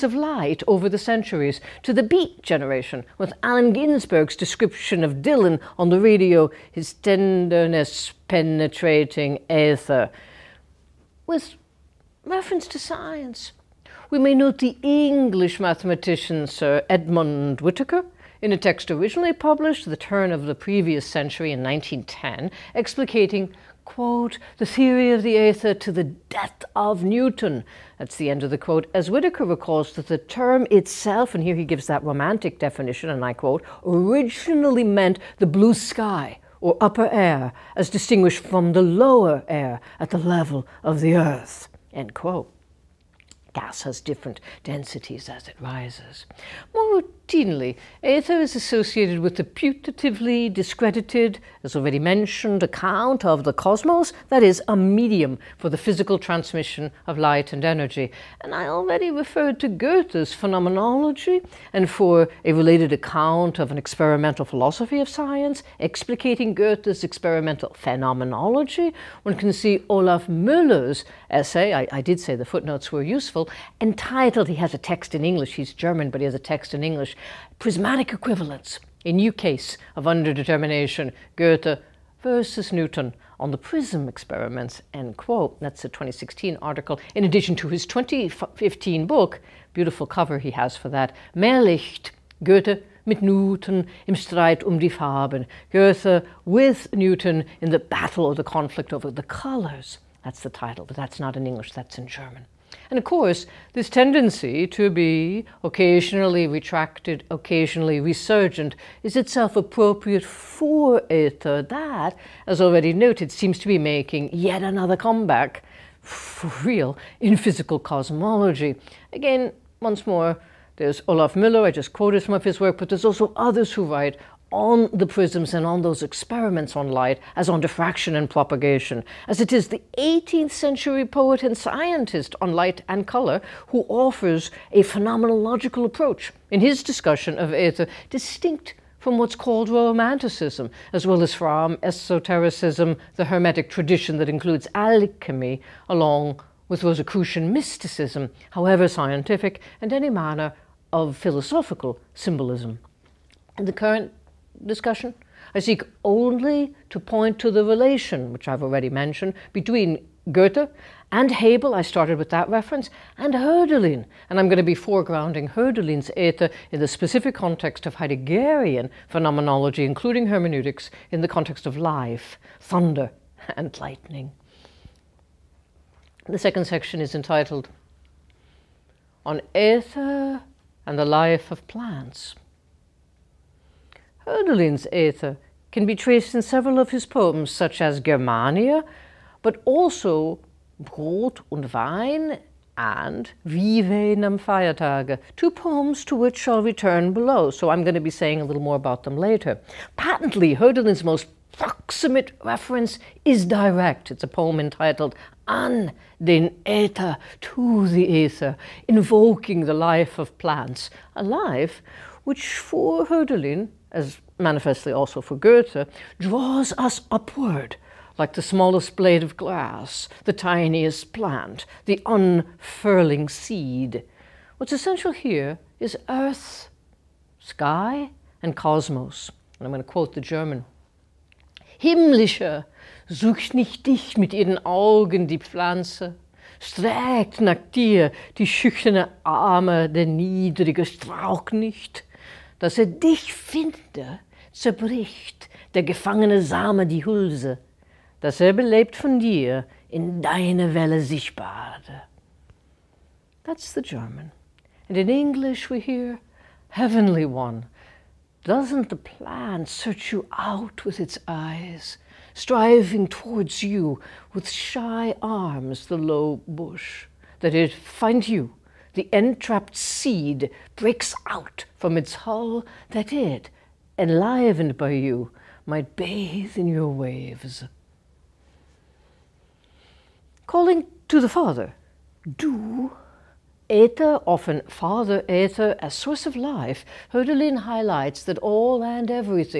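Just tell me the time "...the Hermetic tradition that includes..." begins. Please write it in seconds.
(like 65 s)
143 s.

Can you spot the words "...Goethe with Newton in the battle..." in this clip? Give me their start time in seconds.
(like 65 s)
95 s.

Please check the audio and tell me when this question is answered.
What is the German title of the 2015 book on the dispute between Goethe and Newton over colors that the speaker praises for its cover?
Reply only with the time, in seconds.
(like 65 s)
91 s.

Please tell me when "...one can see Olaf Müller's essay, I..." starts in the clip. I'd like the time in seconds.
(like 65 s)
69 s.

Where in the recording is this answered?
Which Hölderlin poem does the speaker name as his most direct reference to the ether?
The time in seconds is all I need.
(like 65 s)
205 s.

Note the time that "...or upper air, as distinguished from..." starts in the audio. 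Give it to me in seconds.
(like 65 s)
36 s.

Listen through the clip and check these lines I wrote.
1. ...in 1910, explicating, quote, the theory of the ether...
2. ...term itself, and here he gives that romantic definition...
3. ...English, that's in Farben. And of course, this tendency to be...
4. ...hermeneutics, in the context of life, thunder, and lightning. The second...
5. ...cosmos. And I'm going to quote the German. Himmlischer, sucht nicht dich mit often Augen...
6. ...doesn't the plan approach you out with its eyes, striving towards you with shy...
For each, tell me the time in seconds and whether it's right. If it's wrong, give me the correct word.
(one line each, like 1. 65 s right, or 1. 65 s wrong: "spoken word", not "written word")
1. 21 s right
2. 30 s right
3. 101 s wrong: "German", not "Farben"
4. 170 s right
5. 228 s wrong: "ihren", not "often"
6. 258 s wrong: "search", not "approach".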